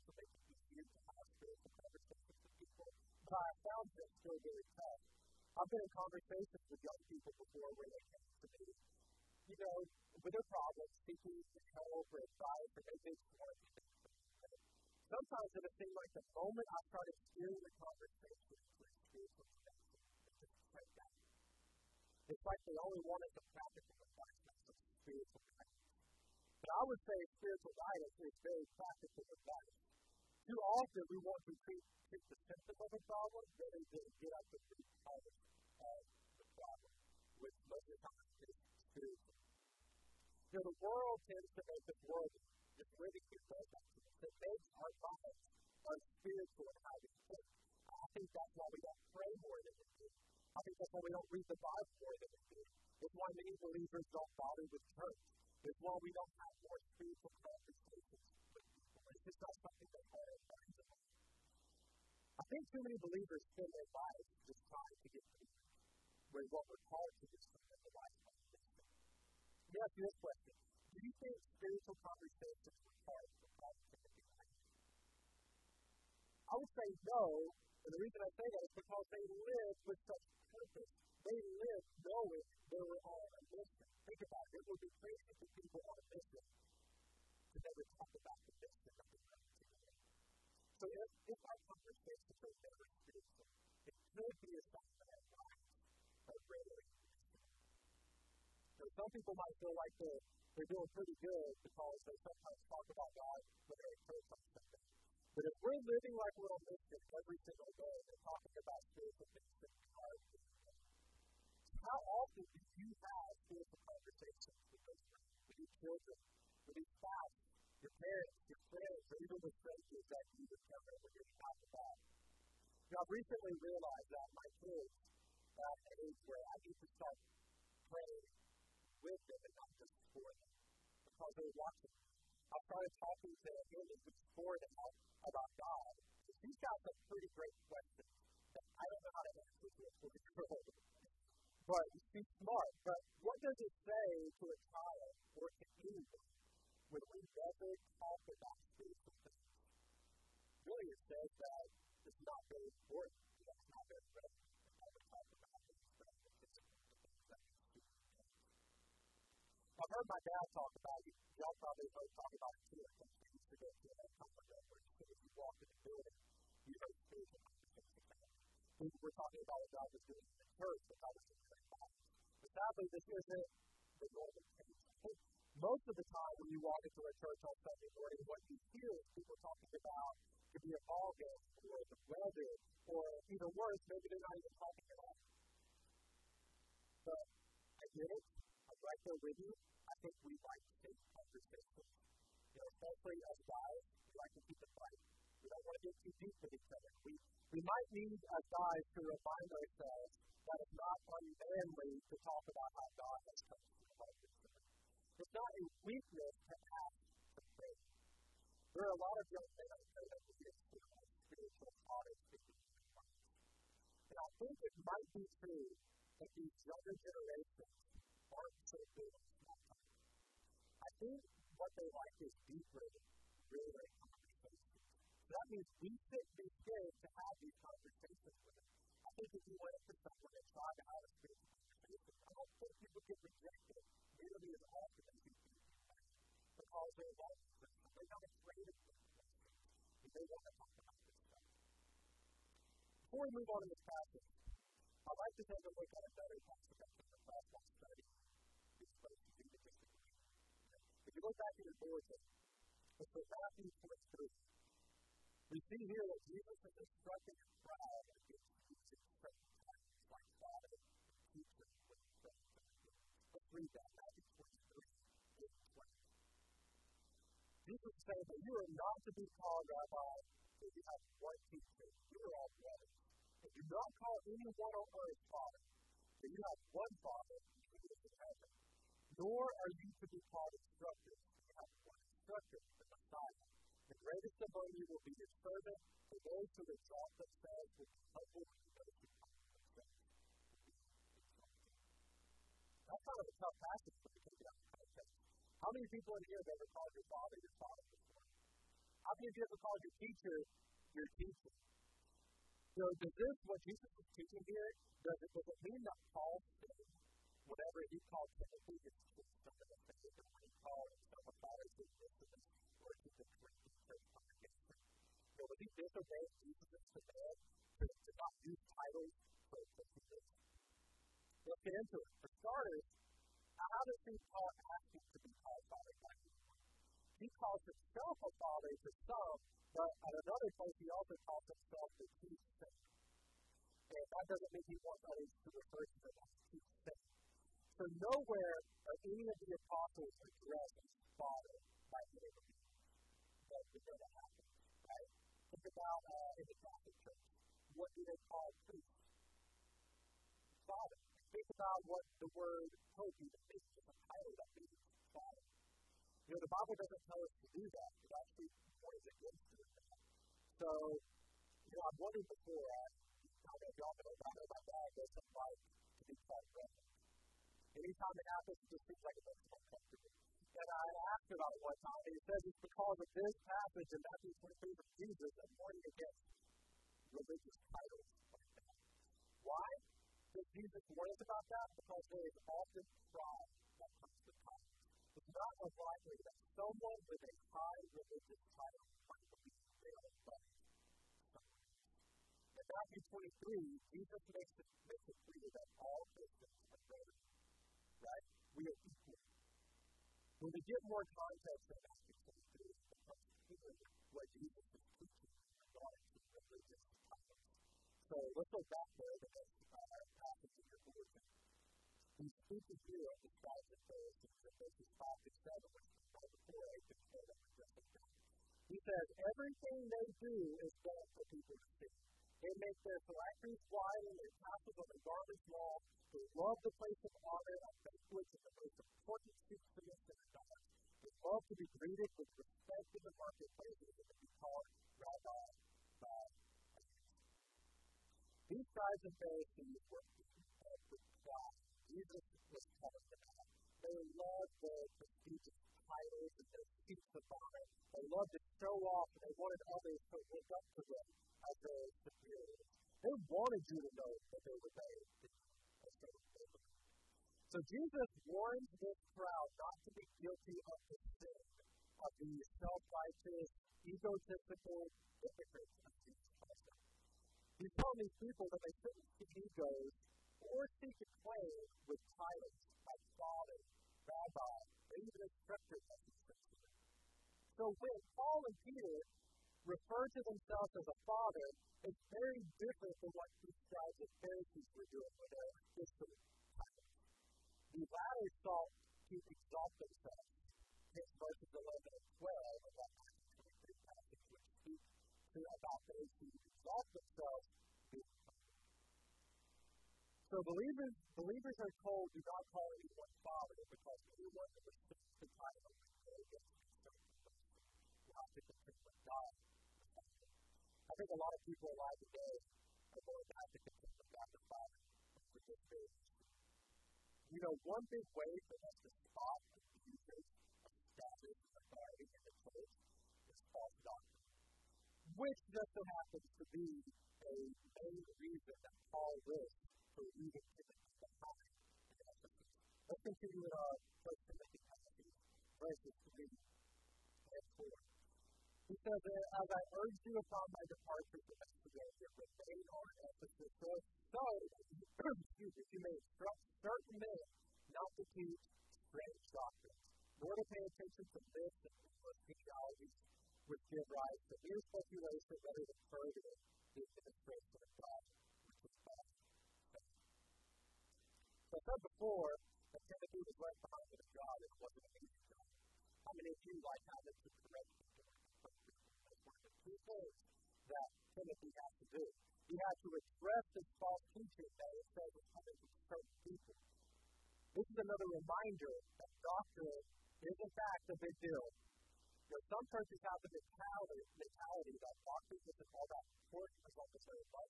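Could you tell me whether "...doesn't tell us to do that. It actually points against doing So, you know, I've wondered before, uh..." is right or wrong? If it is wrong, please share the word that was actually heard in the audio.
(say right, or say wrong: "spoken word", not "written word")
right.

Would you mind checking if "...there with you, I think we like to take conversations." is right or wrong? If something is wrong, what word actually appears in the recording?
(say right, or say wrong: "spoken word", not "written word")
right.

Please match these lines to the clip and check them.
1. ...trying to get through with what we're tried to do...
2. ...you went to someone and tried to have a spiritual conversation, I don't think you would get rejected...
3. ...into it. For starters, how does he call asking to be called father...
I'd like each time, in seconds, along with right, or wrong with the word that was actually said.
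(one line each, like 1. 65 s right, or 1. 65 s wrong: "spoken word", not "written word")
1. 64 s wrong: "called", not "tried"
2. 229 s right
3. 321 s right.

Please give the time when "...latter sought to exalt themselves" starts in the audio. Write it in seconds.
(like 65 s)
487 s.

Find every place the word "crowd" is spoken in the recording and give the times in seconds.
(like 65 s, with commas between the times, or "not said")
257 s, 459 s.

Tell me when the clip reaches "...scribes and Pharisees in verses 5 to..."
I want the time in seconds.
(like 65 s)
413 s.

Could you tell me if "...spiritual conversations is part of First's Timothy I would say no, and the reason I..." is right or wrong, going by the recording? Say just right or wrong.
wrong.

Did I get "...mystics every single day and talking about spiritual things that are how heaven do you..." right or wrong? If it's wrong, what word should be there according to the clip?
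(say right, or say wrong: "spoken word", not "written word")
wrong: "often", not "heaven".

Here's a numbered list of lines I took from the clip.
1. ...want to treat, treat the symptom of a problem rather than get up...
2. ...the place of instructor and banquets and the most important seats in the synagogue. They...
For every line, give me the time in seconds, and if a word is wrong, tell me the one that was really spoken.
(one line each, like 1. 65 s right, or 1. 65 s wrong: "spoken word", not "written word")
1. 31 s right
2. 426 s wrong: "honor", not "instructor".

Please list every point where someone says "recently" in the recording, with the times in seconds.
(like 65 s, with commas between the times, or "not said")
123 s.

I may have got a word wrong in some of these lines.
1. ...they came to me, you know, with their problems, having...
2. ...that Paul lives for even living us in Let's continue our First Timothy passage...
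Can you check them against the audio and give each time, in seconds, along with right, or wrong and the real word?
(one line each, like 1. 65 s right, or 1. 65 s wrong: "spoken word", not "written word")
1. 7 s wrong: "seeking", not "having"
2. 528 s wrong: "giving", not "living".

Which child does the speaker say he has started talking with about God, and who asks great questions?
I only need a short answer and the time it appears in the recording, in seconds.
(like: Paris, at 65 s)
Haley, at 133 s.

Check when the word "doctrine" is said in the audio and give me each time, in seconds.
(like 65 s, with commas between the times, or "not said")
523 s, 549 s, 579 s, 585 s.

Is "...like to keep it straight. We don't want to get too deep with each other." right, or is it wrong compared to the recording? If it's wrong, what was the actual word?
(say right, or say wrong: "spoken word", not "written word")
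wrong: "light", not "straight".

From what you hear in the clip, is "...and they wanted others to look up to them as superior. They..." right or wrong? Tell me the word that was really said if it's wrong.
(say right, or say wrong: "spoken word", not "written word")
right.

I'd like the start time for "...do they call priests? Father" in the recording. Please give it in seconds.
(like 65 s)
347 s.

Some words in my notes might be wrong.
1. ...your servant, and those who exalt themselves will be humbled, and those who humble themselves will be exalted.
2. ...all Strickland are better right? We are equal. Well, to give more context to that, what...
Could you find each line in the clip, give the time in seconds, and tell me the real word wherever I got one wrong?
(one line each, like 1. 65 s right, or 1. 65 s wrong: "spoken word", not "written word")
1. 285 s right
2. 395 s wrong: "Christians", not "Strickland".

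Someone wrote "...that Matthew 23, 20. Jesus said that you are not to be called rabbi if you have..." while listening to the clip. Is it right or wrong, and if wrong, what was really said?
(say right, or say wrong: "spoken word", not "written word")
right.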